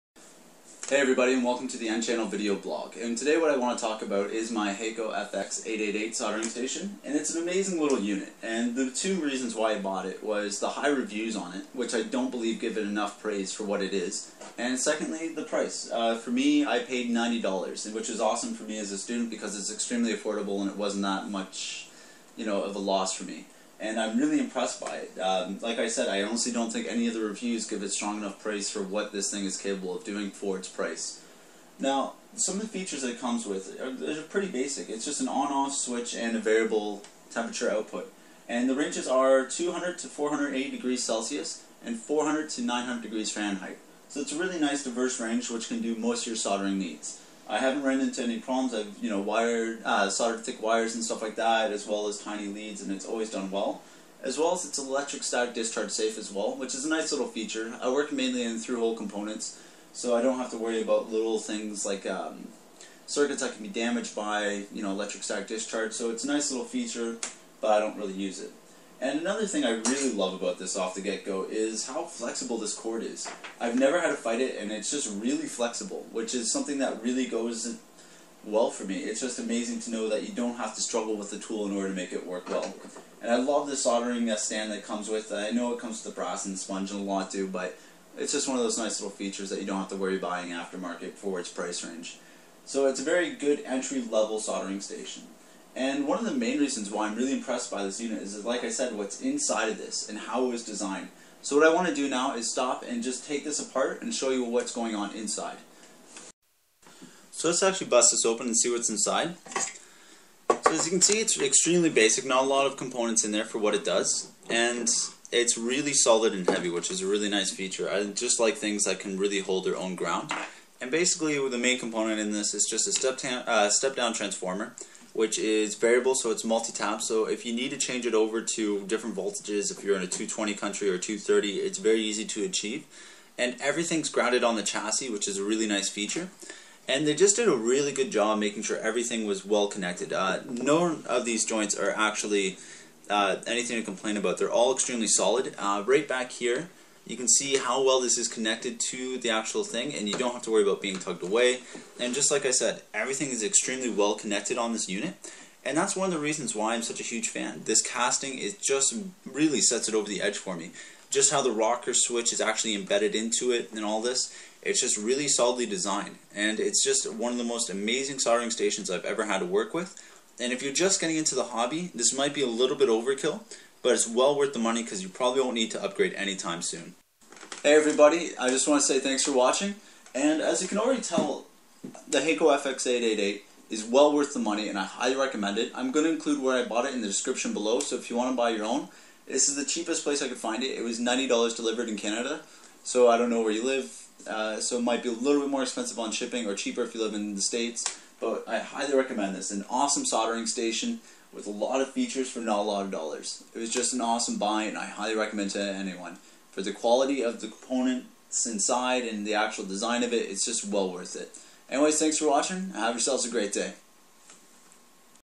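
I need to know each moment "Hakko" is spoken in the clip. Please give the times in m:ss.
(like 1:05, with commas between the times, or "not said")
0:04, 3:02.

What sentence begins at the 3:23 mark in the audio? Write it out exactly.
It was just an awesome buy and I highly recommend to anyone.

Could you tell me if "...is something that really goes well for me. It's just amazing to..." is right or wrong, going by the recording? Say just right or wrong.
right.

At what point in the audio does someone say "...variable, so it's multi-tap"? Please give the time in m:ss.
2:05.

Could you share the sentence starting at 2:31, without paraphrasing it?
And just like I said, everything is extremely well connected on this unit.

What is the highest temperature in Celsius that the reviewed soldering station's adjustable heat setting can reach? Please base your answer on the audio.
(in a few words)
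480 degrees Celsius.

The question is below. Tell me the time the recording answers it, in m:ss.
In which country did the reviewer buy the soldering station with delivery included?
3:11.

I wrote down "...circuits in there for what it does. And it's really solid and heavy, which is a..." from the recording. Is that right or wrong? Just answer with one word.
wrong.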